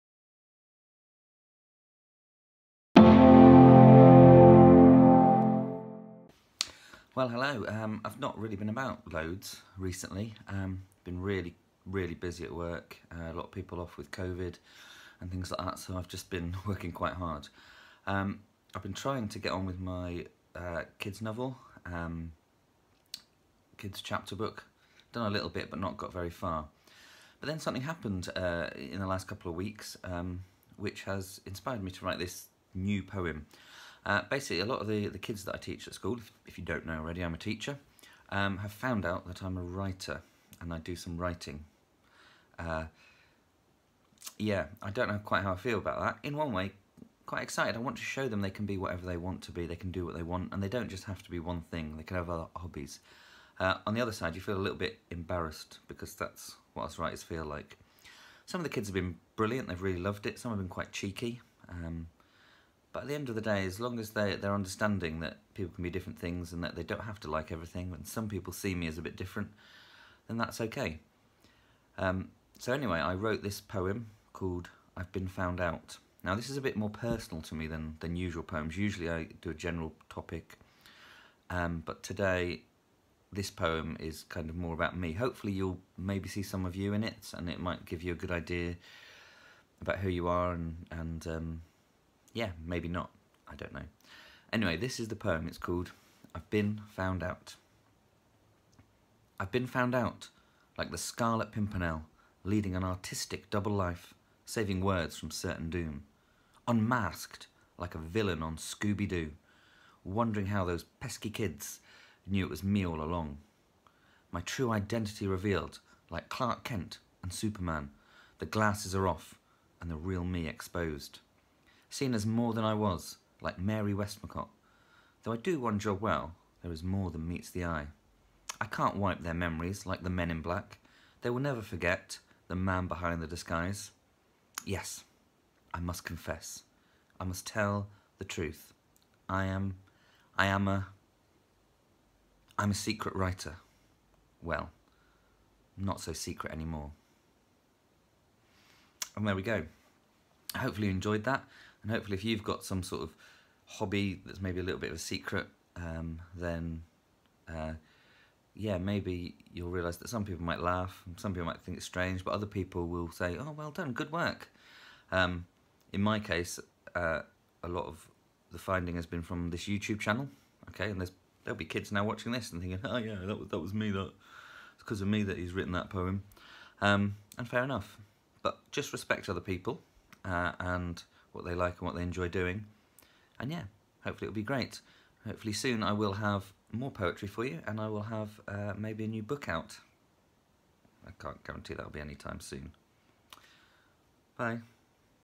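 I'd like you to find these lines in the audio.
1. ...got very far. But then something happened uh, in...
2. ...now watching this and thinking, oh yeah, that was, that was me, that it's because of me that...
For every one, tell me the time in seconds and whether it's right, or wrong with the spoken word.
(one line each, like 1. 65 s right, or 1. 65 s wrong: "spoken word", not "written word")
1. 25 s right
2. 171 s right.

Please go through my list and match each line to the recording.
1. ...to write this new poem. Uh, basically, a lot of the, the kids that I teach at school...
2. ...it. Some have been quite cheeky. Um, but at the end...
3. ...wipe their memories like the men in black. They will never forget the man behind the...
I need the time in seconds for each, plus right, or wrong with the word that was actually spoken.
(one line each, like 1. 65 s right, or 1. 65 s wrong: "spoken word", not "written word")
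1. 31 s right
2. 60 s right
3. 128 s right.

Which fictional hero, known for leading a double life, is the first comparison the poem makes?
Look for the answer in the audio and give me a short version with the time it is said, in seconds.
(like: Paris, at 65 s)
the Scarlet Pimpernel, at 100 s.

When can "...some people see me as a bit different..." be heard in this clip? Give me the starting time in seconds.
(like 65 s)
68 s.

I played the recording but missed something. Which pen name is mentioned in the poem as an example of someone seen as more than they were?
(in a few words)
Mary Westmacott.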